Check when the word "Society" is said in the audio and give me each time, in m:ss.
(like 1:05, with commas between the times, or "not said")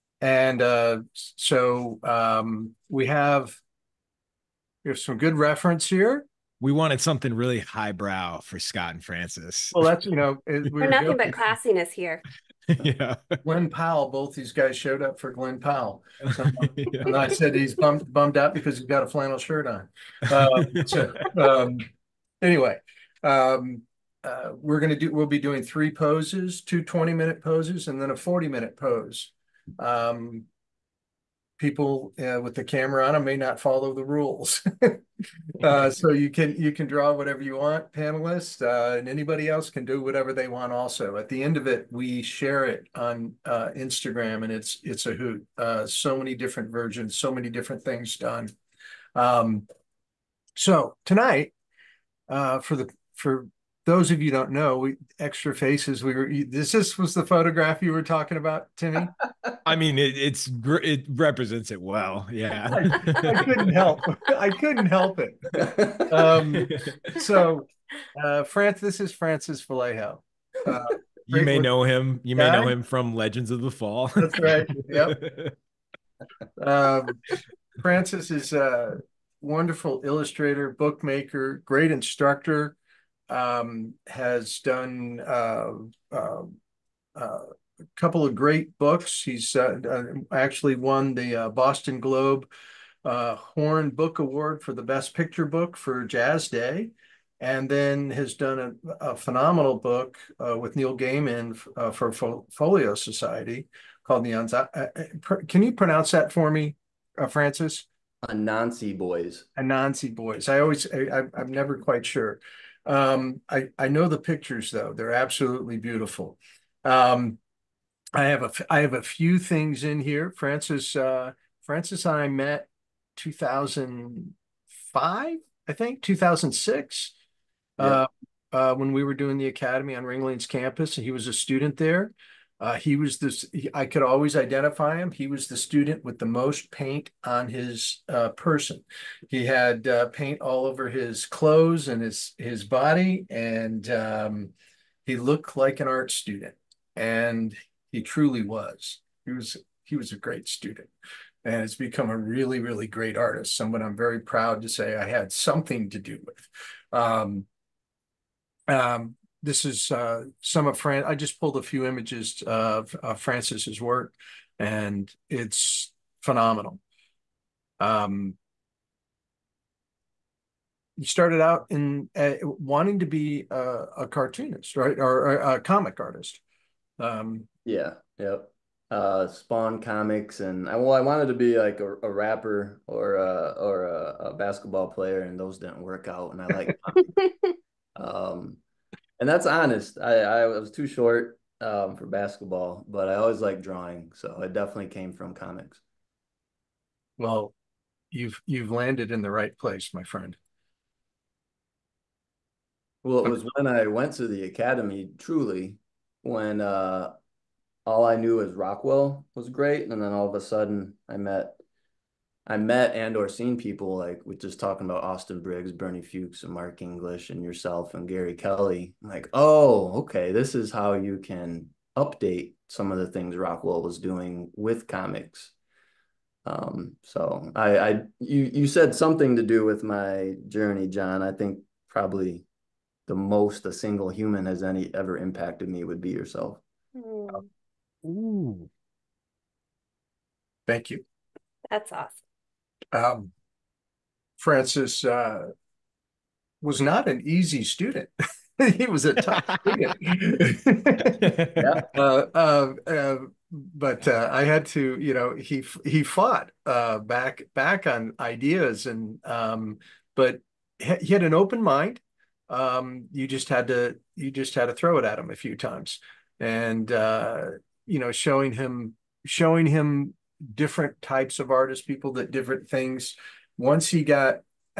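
1:42.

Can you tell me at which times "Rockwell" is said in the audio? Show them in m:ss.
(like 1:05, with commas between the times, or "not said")
3:28, 3:43.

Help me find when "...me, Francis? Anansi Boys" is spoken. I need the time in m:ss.
1:46.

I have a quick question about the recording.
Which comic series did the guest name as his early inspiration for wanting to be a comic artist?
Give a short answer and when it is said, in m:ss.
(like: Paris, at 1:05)
Spawn, at 2:59.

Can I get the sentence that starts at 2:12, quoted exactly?
Uh, he was this, he, I could always identify him.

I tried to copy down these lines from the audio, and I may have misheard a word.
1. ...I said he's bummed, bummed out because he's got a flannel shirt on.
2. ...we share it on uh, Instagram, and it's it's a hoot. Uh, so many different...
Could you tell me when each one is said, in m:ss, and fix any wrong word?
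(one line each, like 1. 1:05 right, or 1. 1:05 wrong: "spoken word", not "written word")
1. 0:17 right
2. 0:41 right.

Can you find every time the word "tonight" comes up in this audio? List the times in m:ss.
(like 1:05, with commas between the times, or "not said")
0:51.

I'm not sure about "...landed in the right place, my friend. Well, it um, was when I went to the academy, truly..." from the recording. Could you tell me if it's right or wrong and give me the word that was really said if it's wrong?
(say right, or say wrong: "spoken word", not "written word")
right.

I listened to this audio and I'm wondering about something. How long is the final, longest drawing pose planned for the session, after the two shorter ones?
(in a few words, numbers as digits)
40 minutes.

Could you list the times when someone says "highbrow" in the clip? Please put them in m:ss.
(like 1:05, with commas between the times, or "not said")
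0:07.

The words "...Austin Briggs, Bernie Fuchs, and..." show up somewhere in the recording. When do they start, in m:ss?
3:35.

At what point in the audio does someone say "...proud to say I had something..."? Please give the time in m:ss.
2:34.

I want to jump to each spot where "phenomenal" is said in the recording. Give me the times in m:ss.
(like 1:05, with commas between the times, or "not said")
1:39, 2:46.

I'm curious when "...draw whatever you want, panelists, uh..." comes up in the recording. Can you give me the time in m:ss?
0:36.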